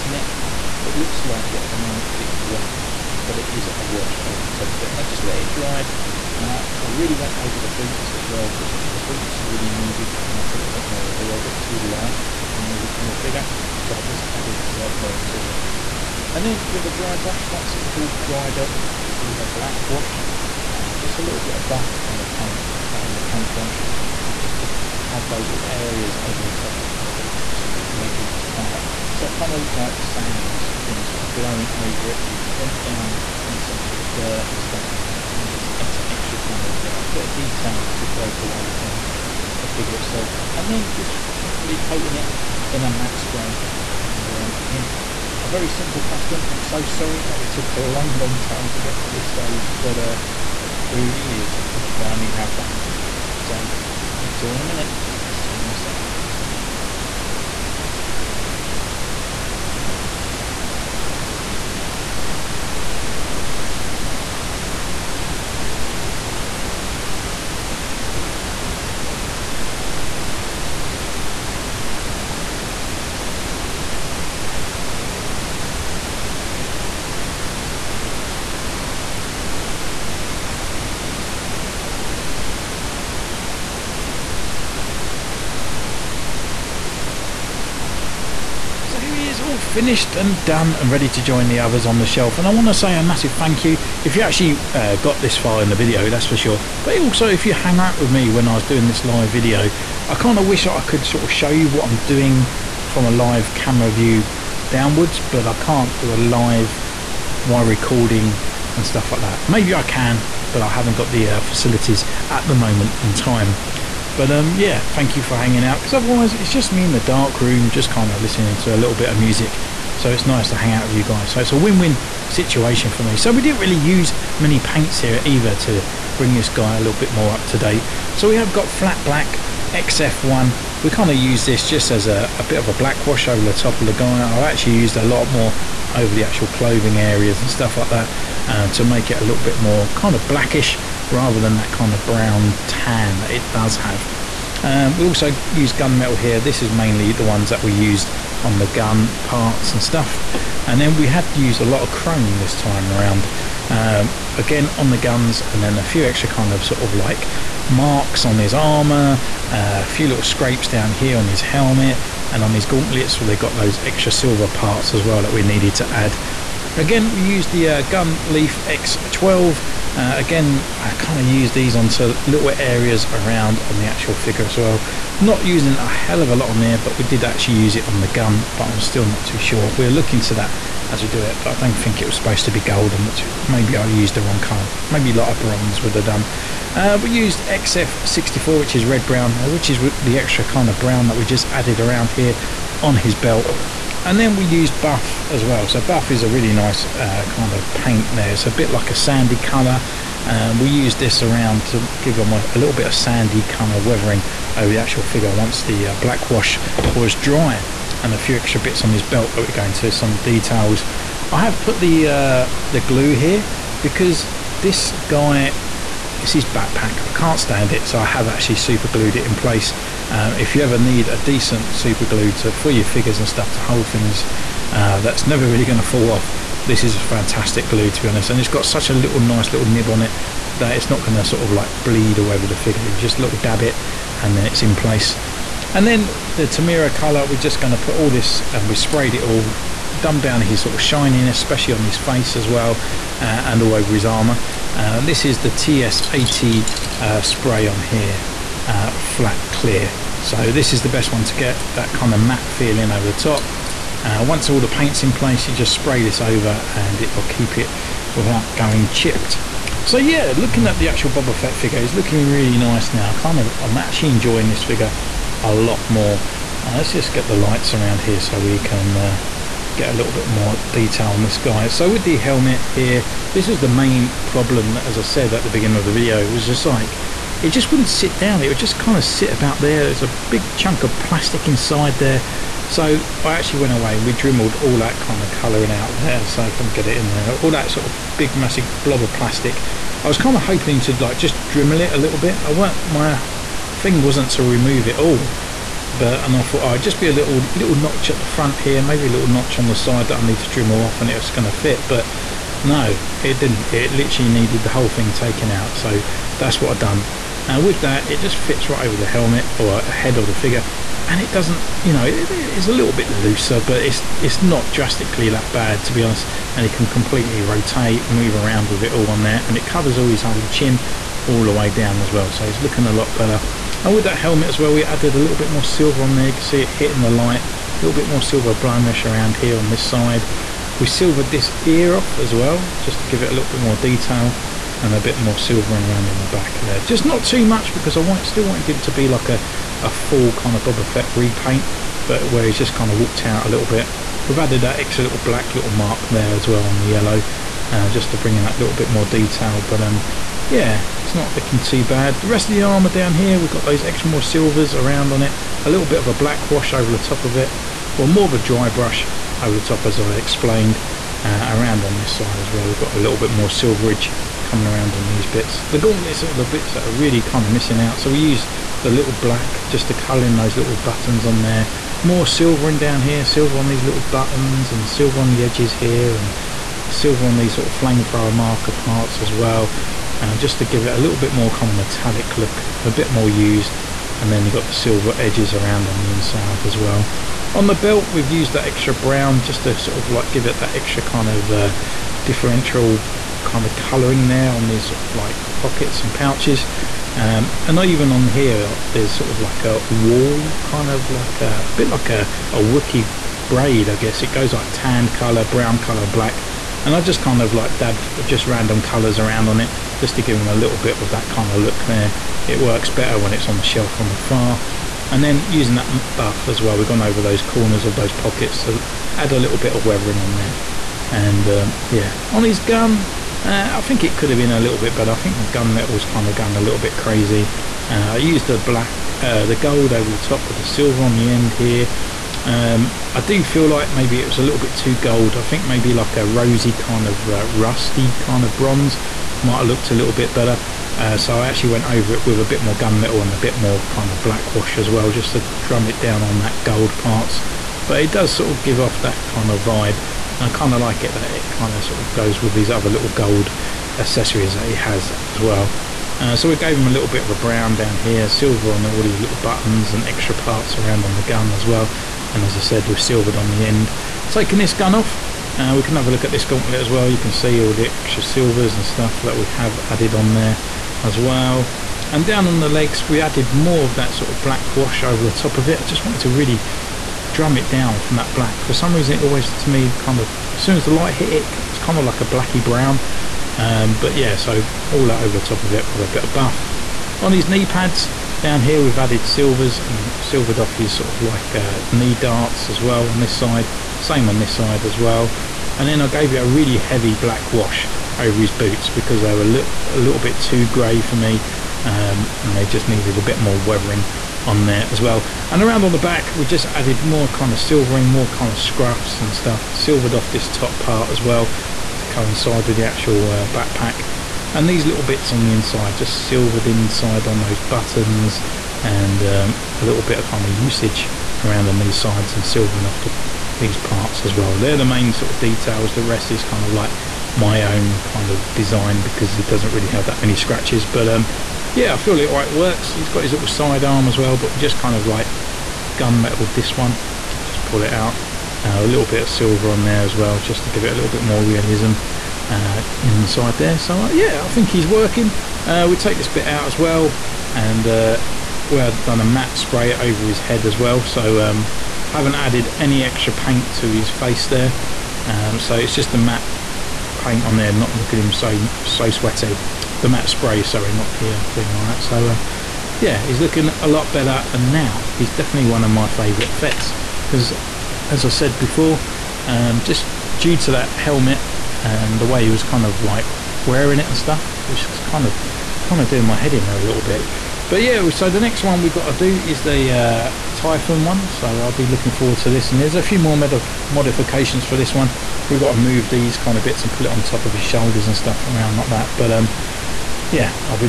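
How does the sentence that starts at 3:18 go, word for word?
It's a bit like a sandy colour.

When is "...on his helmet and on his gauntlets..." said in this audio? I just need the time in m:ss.
2:41.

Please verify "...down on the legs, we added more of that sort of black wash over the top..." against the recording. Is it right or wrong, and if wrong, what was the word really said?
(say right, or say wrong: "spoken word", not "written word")
right.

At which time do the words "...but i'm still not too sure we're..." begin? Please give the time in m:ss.
2:58.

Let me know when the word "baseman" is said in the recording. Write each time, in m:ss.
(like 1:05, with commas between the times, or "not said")
not said.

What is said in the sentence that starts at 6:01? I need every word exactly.
Uh, around on this side as well, we've got a little bit more silverage coming around on these bits.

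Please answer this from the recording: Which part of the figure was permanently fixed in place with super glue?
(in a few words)
His backpack.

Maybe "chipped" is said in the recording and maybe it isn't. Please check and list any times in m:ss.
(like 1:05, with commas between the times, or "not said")
4:18.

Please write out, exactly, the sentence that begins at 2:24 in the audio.
Um, we also use gunmetal here.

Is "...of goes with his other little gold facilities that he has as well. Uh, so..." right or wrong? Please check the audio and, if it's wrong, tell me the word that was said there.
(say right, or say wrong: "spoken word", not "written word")
wrong: "accessories", not "facilities".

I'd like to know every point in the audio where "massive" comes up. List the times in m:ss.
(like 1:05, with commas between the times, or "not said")
1:33, 4:48.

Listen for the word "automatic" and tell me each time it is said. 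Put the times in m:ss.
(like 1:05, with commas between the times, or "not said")
not said.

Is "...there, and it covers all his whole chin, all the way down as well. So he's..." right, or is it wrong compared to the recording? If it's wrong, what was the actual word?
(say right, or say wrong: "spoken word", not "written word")
right.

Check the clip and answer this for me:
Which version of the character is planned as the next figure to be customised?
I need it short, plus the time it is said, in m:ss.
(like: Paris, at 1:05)
Tython, at 9:40.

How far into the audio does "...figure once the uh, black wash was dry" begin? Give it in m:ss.
3:25.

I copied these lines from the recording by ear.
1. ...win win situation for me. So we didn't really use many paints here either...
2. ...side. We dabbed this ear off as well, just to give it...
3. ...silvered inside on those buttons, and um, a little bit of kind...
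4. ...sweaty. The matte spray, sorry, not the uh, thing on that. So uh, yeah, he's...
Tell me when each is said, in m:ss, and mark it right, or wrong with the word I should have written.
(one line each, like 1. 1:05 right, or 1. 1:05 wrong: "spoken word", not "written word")
1. 2:01 right
2. 5:29 wrong: "silvered", not "dabbed"
3. 8:36 right
4. 9:19 right.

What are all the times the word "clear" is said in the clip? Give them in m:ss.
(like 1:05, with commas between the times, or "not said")
4:09.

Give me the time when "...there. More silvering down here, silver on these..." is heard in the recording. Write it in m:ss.
6:11.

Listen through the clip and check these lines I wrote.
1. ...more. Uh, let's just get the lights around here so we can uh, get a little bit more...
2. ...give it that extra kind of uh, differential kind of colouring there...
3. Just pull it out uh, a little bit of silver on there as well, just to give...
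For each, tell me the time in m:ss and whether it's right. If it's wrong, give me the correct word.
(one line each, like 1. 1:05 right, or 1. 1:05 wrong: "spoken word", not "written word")
1. 4:25 right
2. 6:30 right
3. 8:57 right.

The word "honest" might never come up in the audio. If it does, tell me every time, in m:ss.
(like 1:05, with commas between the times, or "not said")
3:48, 5:16.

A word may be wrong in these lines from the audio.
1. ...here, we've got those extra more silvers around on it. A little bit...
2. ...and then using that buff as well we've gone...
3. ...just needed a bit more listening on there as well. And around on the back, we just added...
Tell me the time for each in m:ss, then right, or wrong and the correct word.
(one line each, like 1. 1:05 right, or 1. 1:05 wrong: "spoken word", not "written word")
1. 5:53 right
2. 6:55 right
3. 8:22 wrong: "weathering", not "listening".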